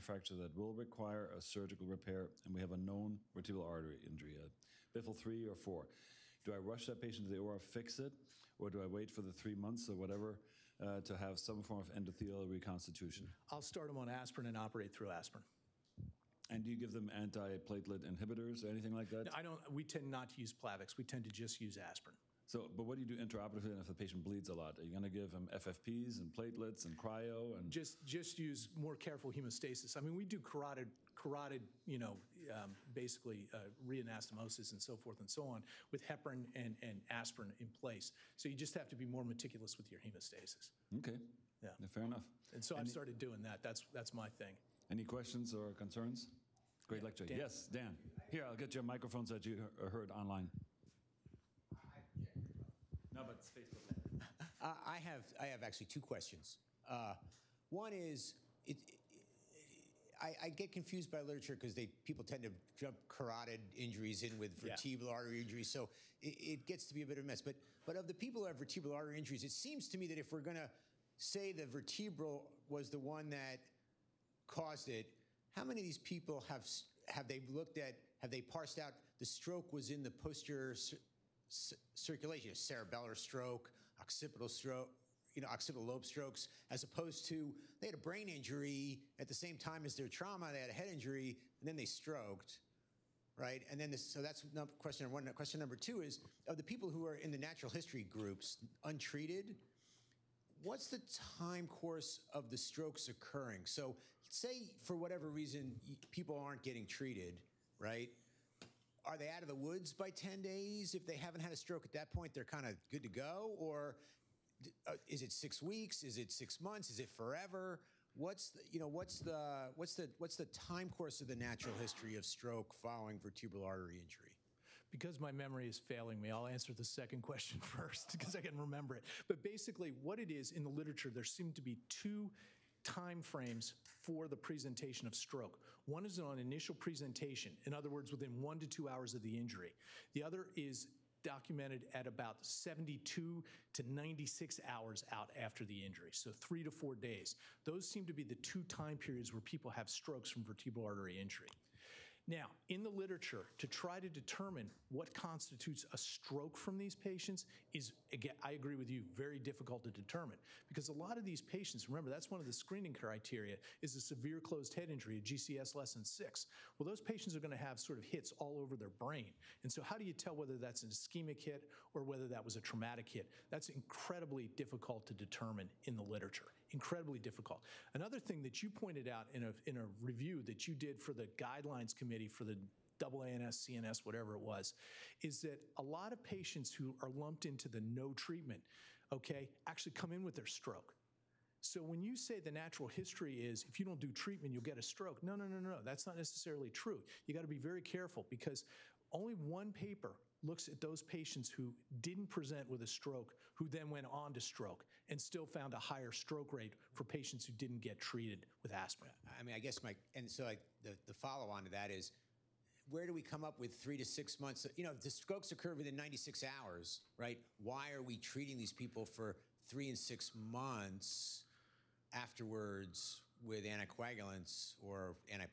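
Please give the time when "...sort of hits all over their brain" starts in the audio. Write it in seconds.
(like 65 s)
167 s.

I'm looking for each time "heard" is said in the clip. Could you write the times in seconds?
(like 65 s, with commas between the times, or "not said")
49 s.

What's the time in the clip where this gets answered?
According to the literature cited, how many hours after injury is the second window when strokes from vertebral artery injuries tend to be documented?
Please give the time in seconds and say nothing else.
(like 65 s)
142 s.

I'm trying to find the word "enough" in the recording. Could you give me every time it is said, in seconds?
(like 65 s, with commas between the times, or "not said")
42 s.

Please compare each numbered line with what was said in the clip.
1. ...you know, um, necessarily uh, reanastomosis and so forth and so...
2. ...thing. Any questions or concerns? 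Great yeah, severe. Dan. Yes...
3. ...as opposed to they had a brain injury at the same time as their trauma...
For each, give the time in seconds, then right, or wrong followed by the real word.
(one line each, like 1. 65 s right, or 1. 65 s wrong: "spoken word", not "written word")
1. 31 s wrong: "basically", not "necessarily"
2. 44 s wrong: "lecture", not "severe"
3. 86 s right.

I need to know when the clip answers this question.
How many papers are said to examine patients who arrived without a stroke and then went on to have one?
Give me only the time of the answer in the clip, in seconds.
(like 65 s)
199 s.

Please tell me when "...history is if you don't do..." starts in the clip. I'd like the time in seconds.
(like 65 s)
192 s.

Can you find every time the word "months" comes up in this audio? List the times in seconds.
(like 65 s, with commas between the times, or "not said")
9 s, 116 s, 214 s, 220 s.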